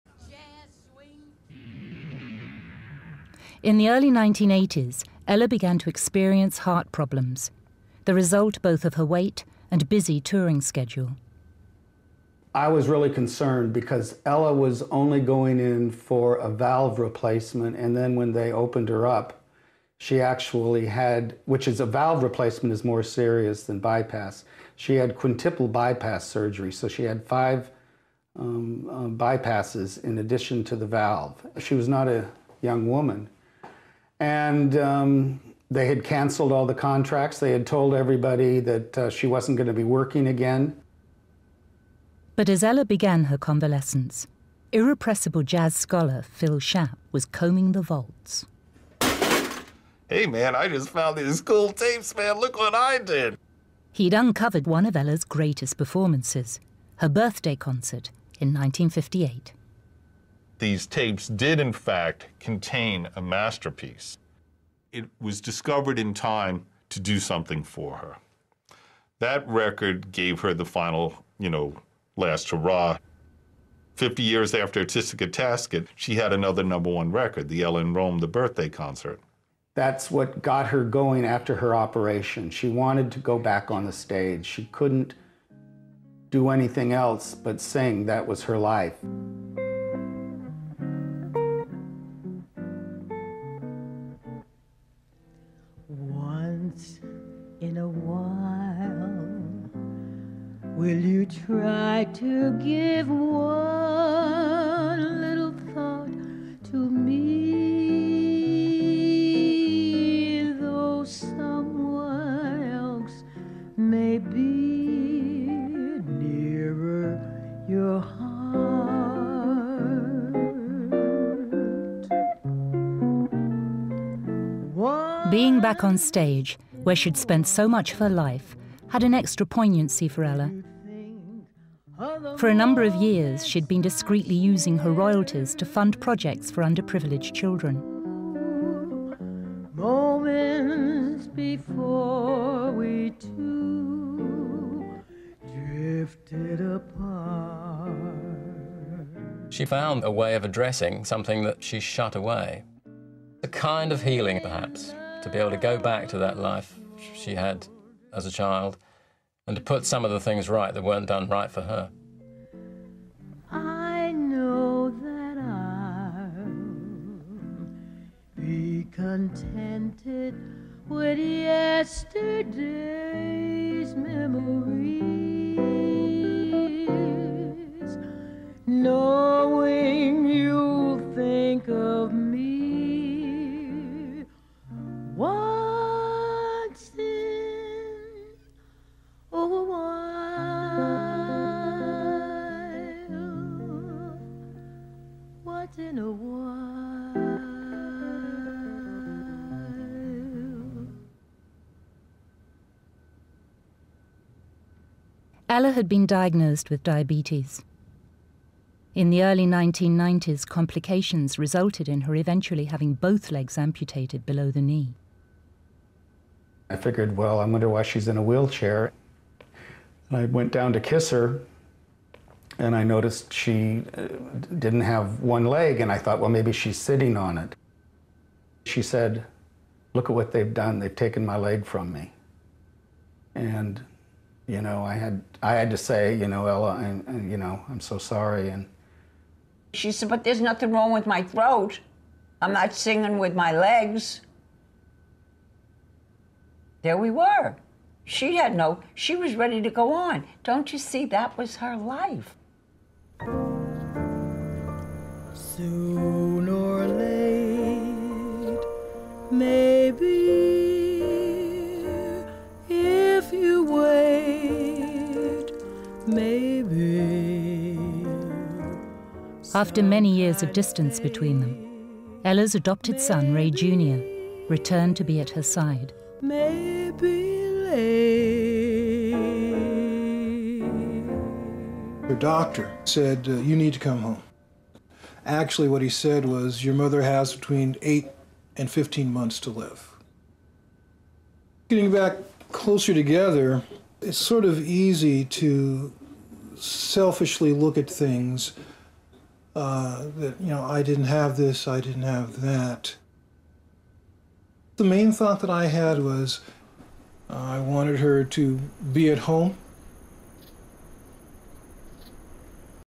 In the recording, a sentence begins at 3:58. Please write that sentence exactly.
And she said, but there's nothing wrong with my throat.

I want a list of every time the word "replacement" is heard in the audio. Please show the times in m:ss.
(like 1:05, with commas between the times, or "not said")
0:16, 0:22.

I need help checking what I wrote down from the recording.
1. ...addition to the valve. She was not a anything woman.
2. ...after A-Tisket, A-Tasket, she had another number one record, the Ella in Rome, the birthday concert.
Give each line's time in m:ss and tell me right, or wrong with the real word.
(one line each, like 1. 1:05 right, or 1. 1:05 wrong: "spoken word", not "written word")
1. 0:30 wrong: "young", not "anything"
2. 1:14 right.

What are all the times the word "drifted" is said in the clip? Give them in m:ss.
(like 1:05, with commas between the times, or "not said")
2:25.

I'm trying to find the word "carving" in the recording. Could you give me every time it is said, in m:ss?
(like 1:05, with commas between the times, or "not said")
not said.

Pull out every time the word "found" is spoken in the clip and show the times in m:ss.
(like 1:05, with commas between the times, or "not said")
0:50, 2:29.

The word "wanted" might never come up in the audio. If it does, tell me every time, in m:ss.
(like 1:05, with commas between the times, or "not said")
1:22, 5:07.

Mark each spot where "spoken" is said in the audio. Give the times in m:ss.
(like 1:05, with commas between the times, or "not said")
not said.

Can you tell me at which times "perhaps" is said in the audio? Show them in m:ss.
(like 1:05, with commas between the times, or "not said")
2:34.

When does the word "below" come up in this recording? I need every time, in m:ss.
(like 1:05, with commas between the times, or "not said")
3:34.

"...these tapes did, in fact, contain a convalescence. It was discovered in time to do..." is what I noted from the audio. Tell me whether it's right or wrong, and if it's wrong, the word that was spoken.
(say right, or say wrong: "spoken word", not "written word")
wrong: "masterpiece", not "convalescence".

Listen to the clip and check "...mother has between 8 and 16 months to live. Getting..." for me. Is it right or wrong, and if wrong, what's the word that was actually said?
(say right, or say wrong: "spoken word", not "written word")
wrong: "15", not "16".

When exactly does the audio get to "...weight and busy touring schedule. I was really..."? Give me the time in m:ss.
0:09.